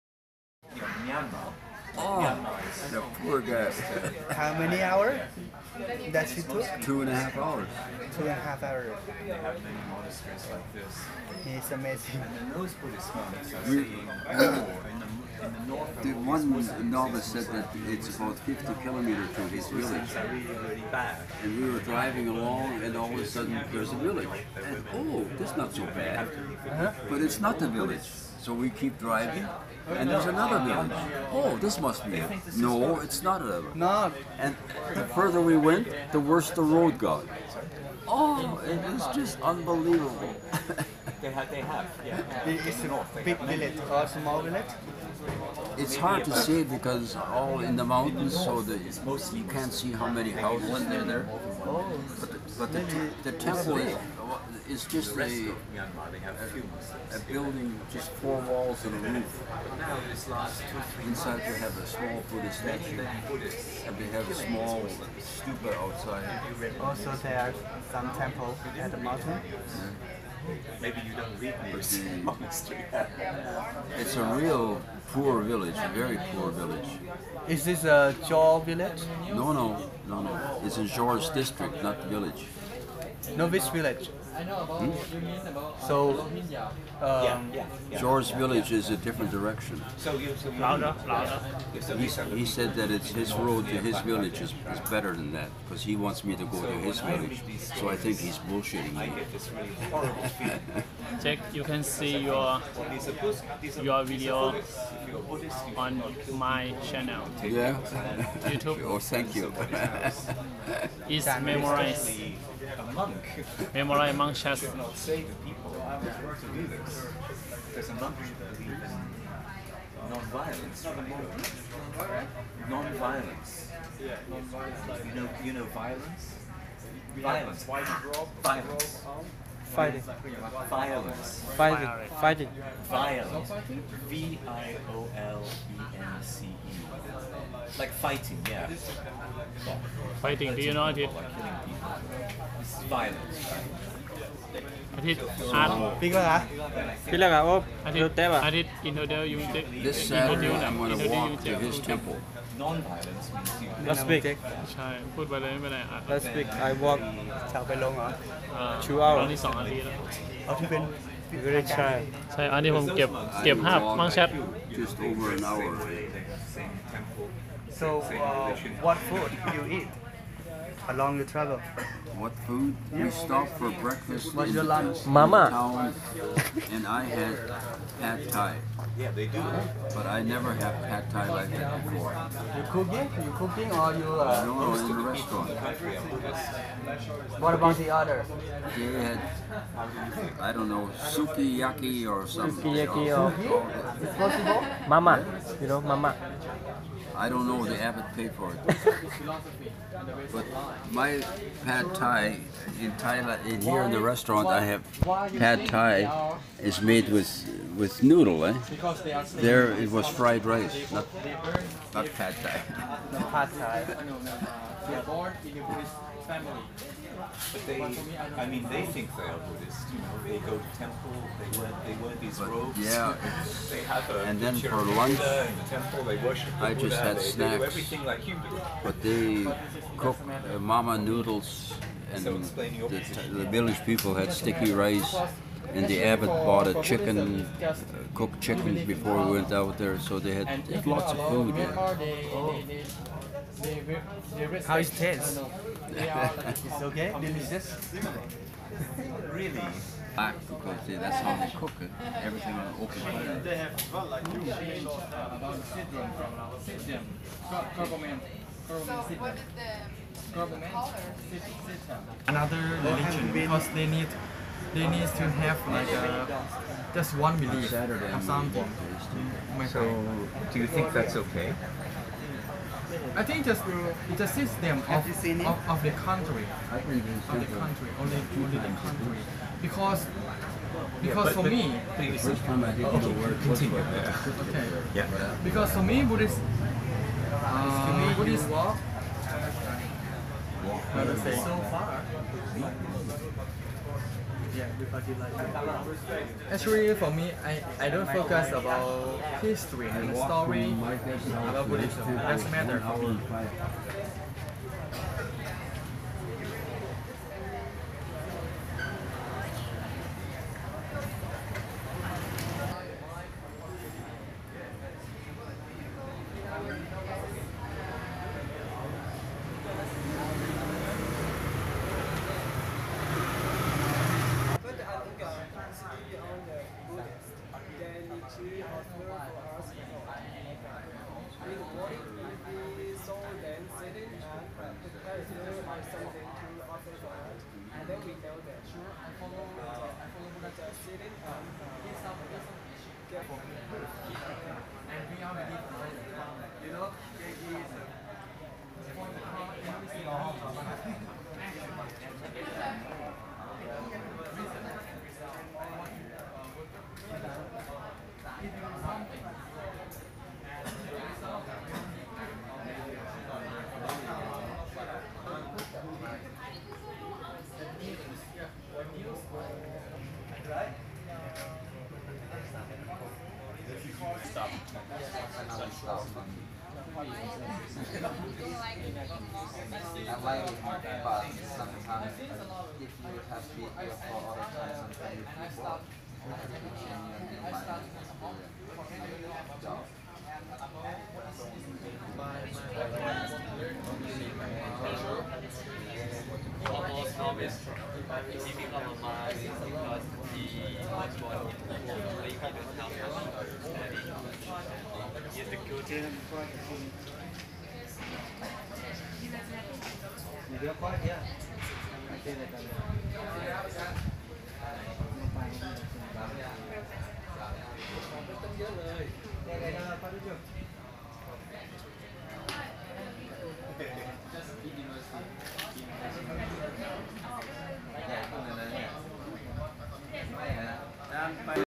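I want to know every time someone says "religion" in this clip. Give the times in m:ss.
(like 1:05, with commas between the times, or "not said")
4:22.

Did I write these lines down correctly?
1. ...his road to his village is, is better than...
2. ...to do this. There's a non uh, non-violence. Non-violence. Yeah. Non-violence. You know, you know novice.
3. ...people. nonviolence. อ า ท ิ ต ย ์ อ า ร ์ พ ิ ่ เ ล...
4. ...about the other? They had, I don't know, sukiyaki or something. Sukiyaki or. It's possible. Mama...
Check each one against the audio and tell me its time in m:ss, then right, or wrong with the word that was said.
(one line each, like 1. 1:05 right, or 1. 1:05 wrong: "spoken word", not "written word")
1. 1:33 right
2. 1:56 wrong: "violence", not "novice"
3. 2:21 wrong: "violence", not "nonviolence"
4. 3:07 right.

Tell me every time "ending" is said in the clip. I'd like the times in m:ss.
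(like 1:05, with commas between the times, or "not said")
not said.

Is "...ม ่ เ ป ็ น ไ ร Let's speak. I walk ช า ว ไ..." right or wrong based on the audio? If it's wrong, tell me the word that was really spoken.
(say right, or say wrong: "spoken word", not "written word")
right.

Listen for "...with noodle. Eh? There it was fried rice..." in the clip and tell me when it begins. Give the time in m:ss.
3:27.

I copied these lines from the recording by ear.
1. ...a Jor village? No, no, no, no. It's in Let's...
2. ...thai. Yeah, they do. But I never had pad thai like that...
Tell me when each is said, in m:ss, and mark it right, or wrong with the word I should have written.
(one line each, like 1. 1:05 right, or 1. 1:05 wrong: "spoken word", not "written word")
1. 1:17 wrong: "Jor", not "Let"
2. 2:58 right.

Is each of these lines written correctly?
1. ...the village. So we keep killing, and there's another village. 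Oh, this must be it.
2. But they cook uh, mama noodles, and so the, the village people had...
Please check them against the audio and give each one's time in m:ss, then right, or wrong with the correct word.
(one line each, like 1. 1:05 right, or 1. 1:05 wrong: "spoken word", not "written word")
1. 0:27 wrong: "driving", not "killing"
2. 3:48 right.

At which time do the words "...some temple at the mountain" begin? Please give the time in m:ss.
1:07.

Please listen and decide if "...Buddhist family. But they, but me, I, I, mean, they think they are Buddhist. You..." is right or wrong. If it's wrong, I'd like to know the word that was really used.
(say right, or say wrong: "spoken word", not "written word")
right.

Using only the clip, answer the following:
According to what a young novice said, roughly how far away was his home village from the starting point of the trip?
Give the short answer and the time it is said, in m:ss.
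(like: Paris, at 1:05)
50 kilometers, at 0:18.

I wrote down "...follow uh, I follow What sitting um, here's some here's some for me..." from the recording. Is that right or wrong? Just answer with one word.
wrong.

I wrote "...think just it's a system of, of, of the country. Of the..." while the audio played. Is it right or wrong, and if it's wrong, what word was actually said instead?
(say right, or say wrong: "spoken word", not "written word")
right.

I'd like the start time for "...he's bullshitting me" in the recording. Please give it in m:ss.
1:38.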